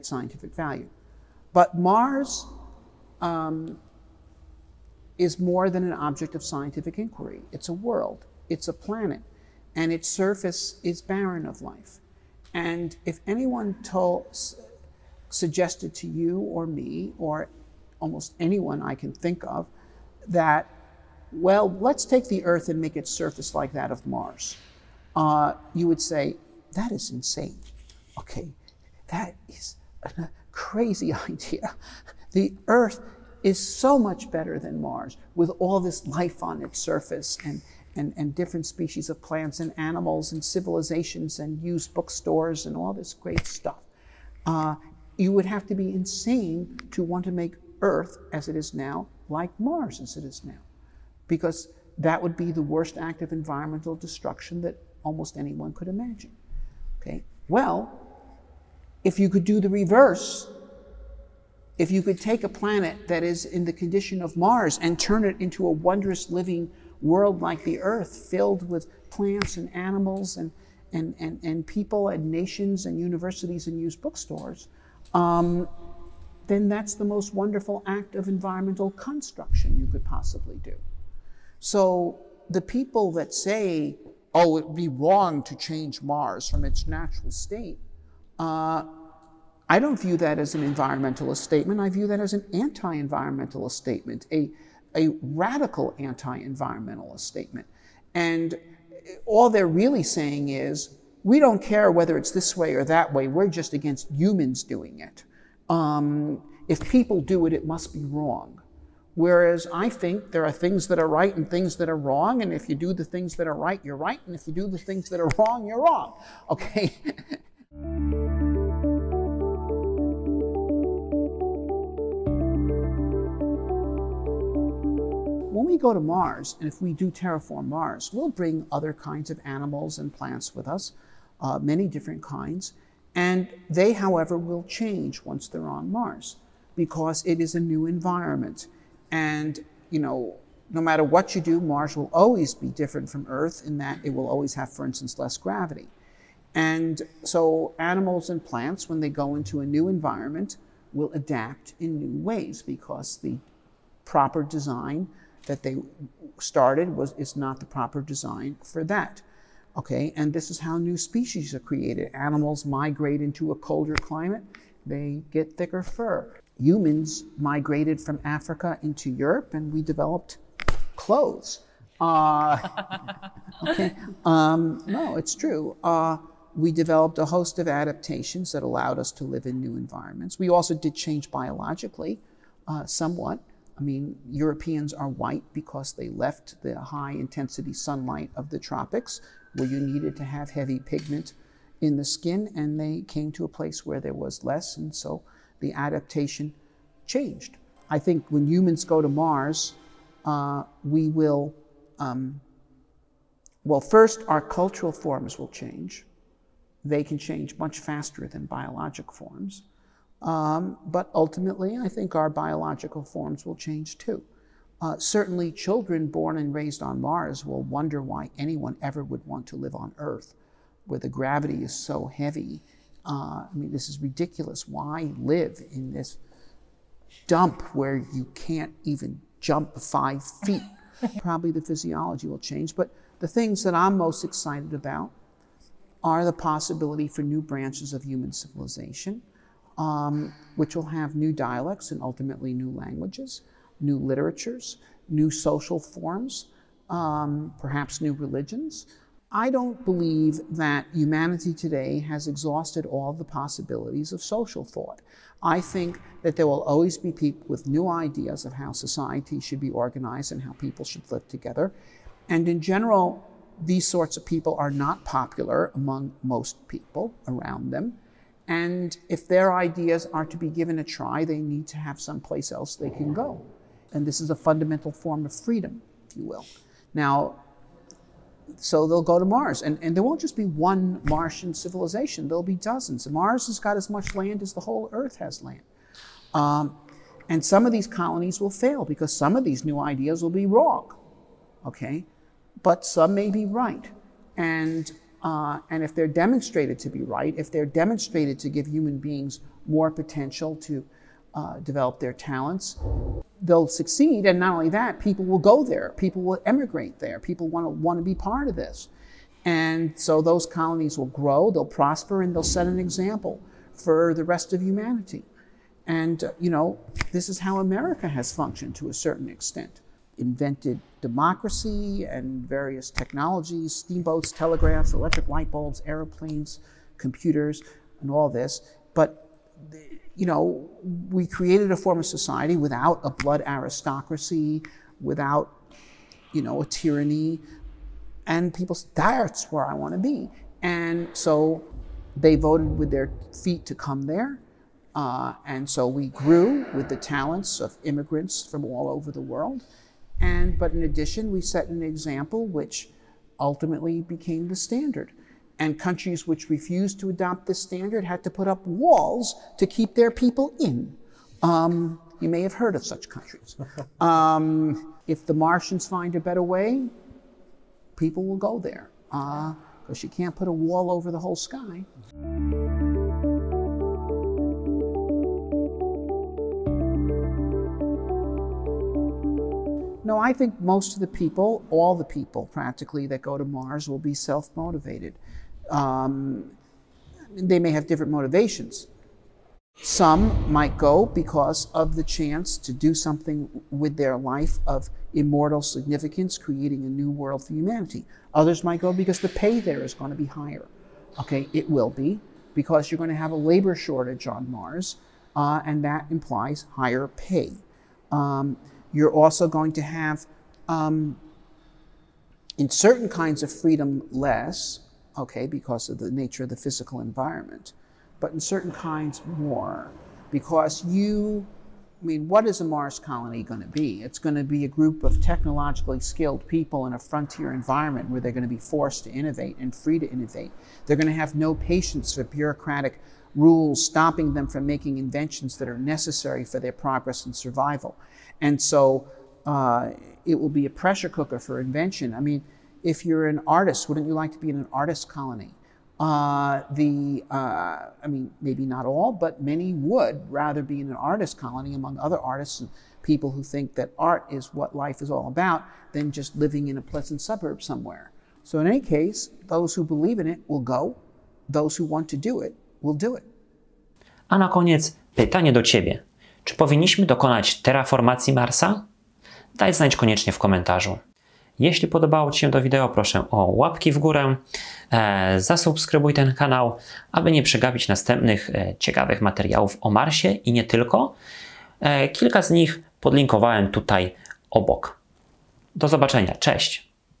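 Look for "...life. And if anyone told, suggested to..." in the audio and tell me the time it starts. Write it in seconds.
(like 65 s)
11 s.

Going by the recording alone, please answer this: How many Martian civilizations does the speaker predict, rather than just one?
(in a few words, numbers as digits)
dozens.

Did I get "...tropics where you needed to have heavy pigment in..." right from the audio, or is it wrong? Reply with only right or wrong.
right.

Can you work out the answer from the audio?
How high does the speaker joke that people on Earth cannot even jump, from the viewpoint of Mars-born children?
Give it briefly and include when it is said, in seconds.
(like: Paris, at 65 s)
5 feet, at 229 s.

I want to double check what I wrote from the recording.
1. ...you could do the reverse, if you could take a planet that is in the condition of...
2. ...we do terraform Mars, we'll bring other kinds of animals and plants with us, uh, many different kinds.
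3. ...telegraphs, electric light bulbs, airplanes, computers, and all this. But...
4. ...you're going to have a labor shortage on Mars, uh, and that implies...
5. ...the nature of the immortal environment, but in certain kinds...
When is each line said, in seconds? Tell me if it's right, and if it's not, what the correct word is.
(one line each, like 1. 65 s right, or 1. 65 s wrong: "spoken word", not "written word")
1. 59 s right
2. 126 s right
3. 324 s right
4. 402 s right
5. 415 s wrong: "physical", not "immortal".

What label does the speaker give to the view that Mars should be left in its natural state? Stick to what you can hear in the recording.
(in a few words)
radical anti environmentalist.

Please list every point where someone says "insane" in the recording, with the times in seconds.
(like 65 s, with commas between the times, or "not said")
27 s, 45 s.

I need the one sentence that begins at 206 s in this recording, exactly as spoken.
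They can change much faster than biologic forms.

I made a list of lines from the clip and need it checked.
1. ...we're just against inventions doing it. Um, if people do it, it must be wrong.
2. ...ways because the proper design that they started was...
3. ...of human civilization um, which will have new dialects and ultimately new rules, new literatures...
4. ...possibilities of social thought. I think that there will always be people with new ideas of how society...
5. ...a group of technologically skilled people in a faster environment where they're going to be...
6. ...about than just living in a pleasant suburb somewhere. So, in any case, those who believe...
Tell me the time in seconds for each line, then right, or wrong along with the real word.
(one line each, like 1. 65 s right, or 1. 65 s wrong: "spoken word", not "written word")
1. 103 s wrong: "humans", not "inventions"
2. 152 s right
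3. 237 s wrong: "languages", not "rules"
4. 253 s right
5. 424 s wrong: "frontier", not "faster"
6. 455 s right.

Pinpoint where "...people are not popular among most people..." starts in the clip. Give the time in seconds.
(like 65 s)
264 s.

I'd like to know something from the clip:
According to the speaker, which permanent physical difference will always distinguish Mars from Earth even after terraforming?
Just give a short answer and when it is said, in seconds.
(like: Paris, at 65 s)
less gravity, at 145 s.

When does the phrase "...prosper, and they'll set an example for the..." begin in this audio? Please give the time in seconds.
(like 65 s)
311 s.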